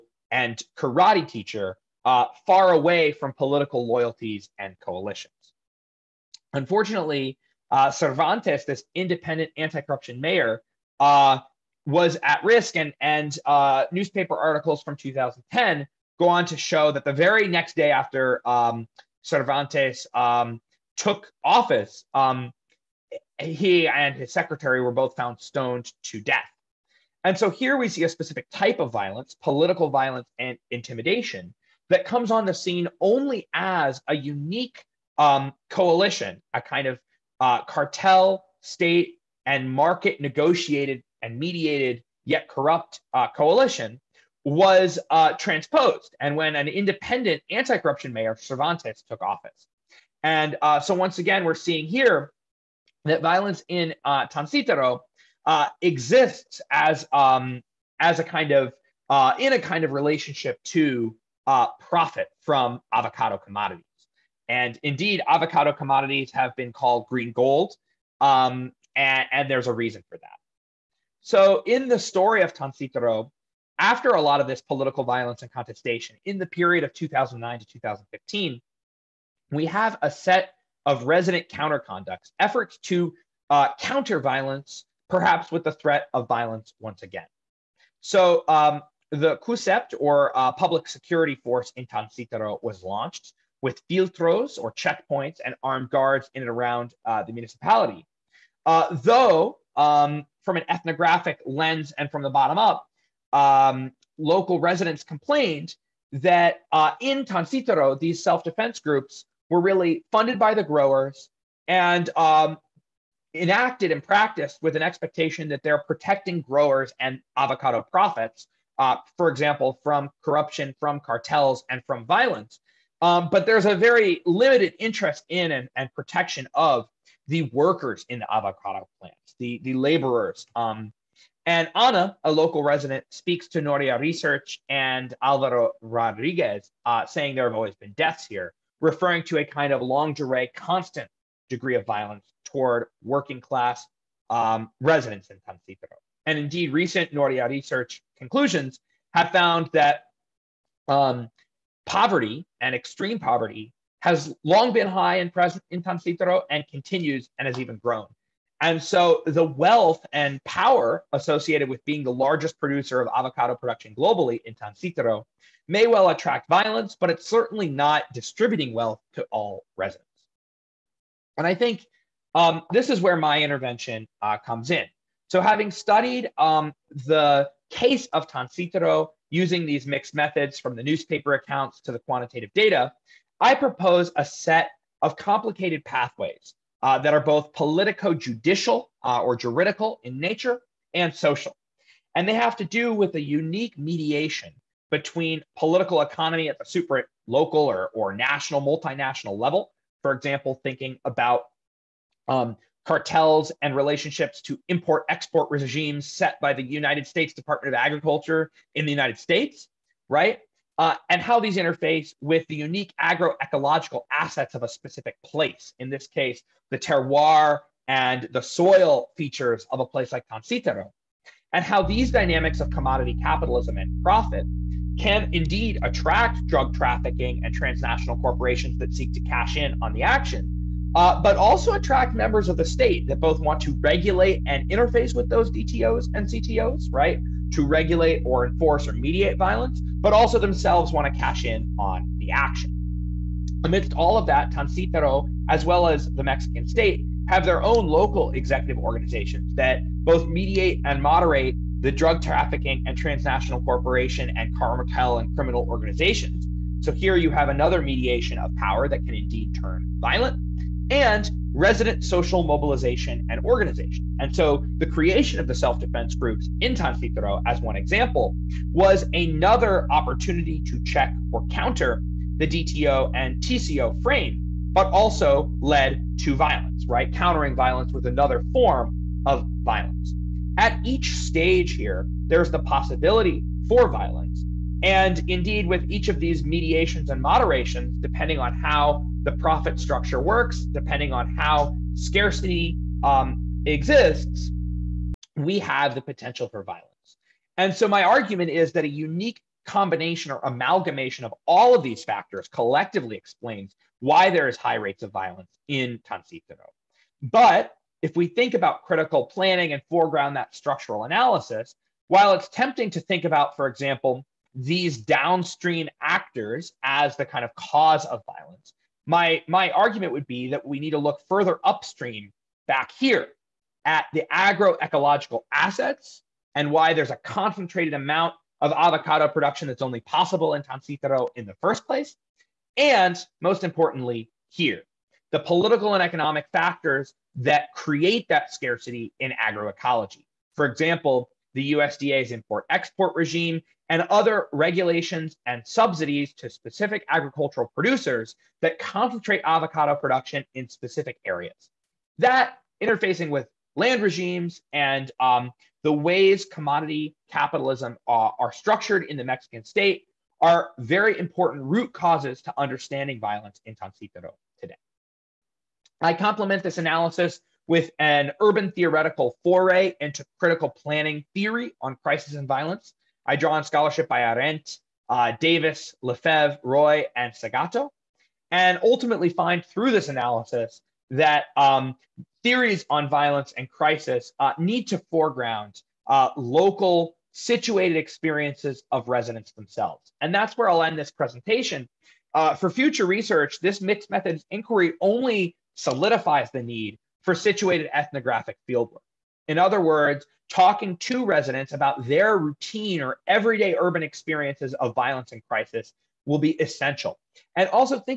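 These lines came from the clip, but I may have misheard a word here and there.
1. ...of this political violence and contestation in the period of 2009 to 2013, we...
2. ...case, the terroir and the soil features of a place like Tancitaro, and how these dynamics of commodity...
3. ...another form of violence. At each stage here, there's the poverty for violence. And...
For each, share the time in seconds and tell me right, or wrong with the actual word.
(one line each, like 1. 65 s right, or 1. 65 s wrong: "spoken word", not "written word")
1. 74 s wrong: "2015", not "2013"
2. 216 s right
3. 278 s wrong: "possibility", not "poverty".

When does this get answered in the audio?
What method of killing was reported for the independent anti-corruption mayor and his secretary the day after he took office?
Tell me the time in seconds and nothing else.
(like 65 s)
25 s.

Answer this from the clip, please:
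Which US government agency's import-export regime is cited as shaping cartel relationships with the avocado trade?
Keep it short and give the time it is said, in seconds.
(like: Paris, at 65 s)
United States Department of Agriculture, at 206 s.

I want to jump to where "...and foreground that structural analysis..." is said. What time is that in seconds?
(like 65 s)
309 s.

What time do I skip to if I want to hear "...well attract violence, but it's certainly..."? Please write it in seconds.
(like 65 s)
165 s.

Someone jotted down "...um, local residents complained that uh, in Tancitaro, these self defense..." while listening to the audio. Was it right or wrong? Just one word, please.
right.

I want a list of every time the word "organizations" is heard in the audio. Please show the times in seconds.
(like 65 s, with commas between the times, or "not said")
248 s, 255 s, 263 s.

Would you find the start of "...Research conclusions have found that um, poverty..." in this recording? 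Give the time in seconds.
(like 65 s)
147 s.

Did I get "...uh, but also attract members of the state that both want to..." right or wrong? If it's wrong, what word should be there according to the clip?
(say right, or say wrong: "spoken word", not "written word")
right.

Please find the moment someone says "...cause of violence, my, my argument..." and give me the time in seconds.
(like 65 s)
317 s.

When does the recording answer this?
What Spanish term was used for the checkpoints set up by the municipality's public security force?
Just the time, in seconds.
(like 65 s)
93 s.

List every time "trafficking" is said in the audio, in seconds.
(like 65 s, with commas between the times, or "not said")
226 s, 252 s.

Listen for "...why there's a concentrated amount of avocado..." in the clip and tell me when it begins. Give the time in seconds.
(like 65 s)
326 s.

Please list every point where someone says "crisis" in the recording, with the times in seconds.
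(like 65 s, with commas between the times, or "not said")
372 s, 383 s, 405 s.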